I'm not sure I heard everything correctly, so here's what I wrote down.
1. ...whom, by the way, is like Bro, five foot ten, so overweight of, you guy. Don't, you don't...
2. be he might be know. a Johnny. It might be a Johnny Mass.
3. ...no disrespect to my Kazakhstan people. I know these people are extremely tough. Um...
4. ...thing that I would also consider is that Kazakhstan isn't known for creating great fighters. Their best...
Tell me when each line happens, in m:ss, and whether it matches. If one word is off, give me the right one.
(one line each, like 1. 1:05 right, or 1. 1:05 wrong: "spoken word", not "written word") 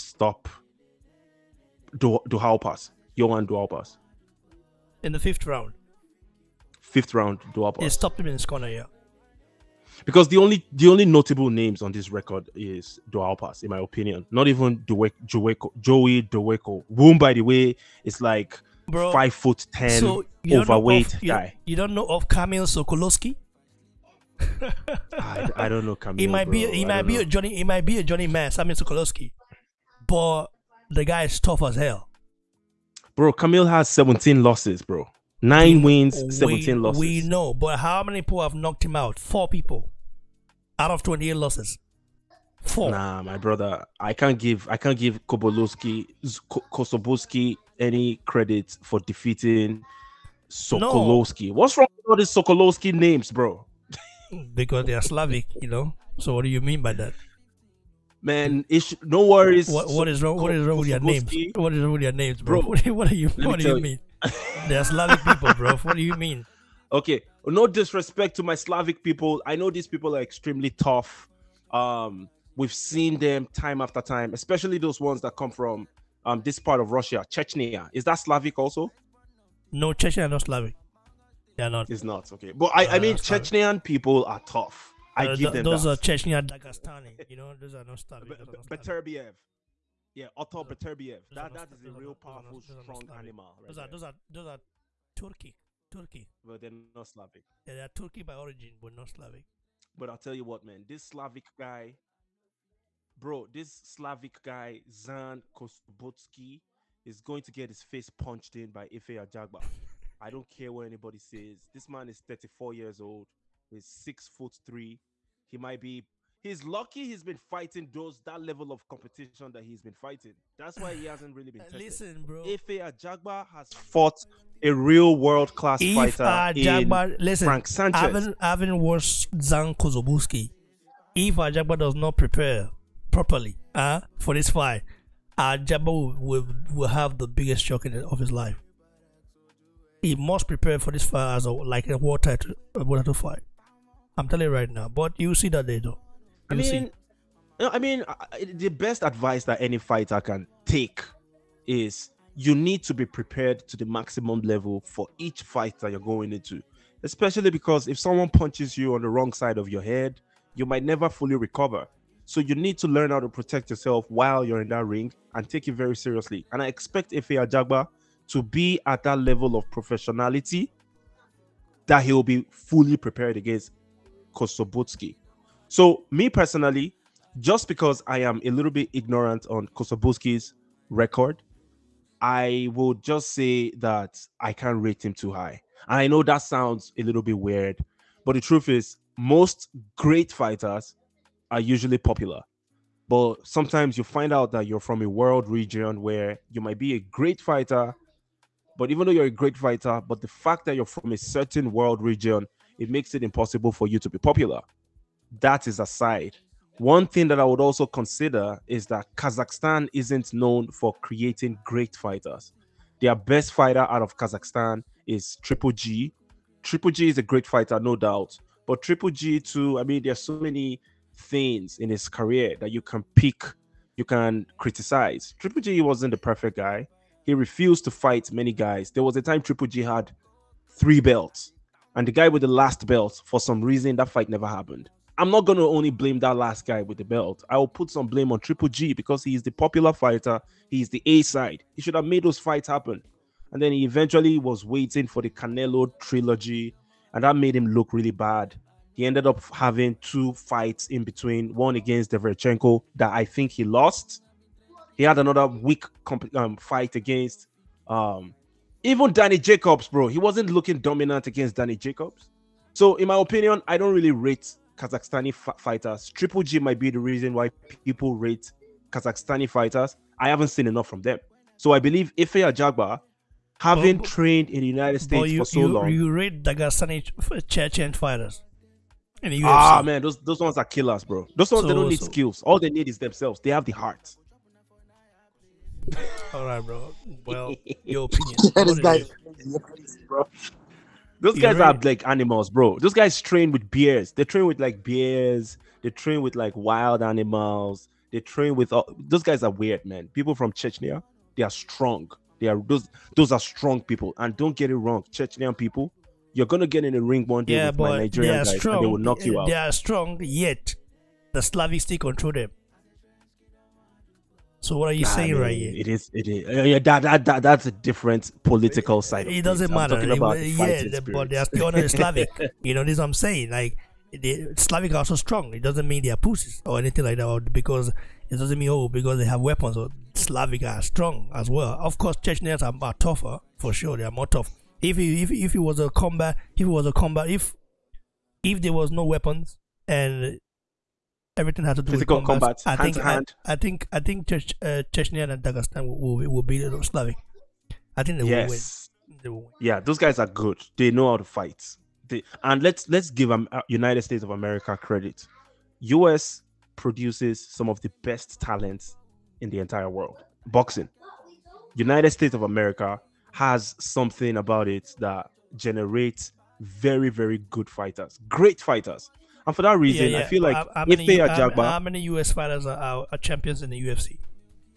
1. 0:16 right
2. 0:26 right
3. 1:07 wrong: "Slavic", not "Kazakhstan"
4. 3:27 right.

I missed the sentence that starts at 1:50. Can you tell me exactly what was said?
I don't care what anybody says.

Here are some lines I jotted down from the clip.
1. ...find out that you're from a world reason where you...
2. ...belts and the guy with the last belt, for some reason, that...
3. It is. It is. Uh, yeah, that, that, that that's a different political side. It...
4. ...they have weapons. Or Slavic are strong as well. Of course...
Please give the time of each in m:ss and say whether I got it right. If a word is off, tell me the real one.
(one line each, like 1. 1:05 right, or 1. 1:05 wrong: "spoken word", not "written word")
1. 3:14 wrong: "region", not "reason"
2. 3:50 right
3. 5:15 right
4. 5:29 right.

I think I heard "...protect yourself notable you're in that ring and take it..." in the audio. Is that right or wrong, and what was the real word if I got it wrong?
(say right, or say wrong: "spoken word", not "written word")
wrong: "while", not "notable".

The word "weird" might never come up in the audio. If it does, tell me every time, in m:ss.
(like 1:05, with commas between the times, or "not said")
3:07, 4:59.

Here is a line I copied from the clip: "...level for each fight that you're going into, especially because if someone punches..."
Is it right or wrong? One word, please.
right.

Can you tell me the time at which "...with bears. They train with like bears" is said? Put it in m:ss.
4:53.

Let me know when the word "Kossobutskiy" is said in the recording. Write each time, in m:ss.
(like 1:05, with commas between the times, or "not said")
0:46, 1:45, 2:09, 2:54, 2:59.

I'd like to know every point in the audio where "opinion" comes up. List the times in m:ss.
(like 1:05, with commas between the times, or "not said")
0:13, 4:23, 4:48.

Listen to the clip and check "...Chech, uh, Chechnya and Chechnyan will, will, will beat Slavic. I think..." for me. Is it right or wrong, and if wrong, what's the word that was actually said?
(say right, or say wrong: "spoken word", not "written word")
wrong: "Dagestan", not "Chechnyan".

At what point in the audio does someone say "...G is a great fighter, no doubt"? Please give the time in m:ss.
3:36.